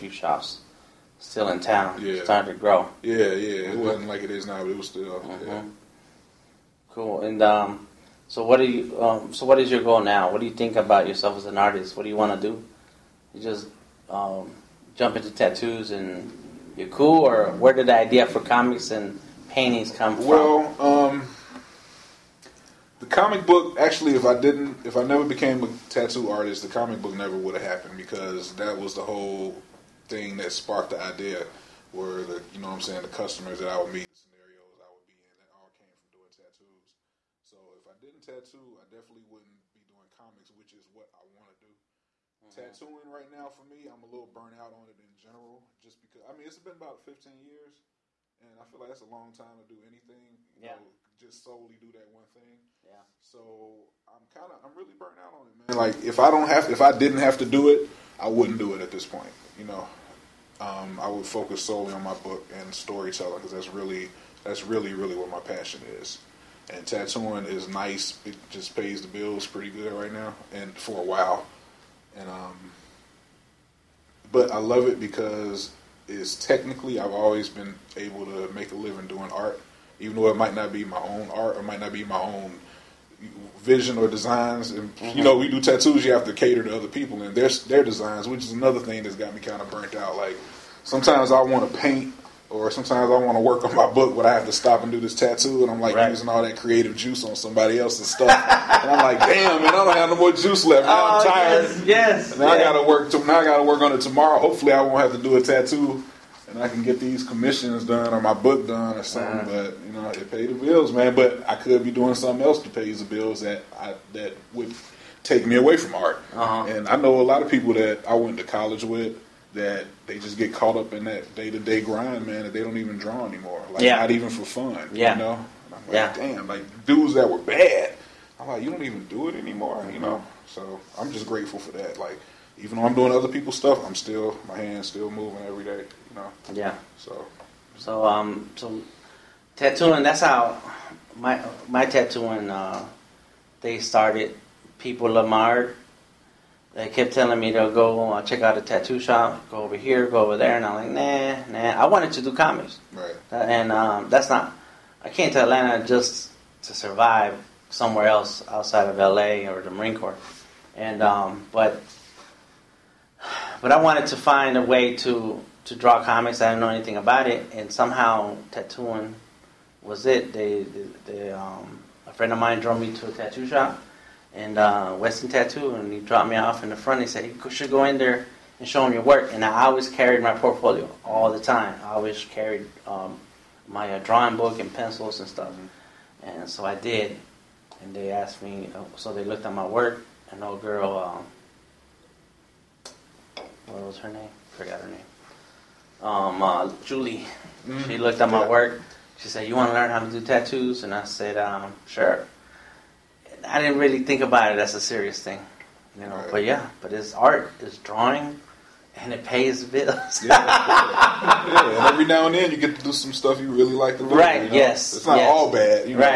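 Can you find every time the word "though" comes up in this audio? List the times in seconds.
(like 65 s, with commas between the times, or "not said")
80 s, 132 s.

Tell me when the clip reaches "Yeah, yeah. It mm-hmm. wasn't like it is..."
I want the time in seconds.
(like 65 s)
3 s.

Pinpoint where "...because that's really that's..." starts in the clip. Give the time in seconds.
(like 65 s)
63 s.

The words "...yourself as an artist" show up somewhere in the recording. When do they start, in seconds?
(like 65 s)
11 s.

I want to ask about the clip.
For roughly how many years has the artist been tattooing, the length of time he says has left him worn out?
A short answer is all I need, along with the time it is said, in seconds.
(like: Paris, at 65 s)
15 years, at 46 s.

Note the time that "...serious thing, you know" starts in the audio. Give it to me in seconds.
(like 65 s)
204 s.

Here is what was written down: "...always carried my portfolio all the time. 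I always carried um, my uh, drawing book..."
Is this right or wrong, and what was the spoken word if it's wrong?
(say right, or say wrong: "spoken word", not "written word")
right.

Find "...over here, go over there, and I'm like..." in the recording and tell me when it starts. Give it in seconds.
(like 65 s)
149 s.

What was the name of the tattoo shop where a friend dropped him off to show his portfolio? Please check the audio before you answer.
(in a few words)
Weston Tattoo.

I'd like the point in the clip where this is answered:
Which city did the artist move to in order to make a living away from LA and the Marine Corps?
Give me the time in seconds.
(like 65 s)
155 s.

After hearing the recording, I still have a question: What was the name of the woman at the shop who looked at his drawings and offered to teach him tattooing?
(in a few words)
Julie.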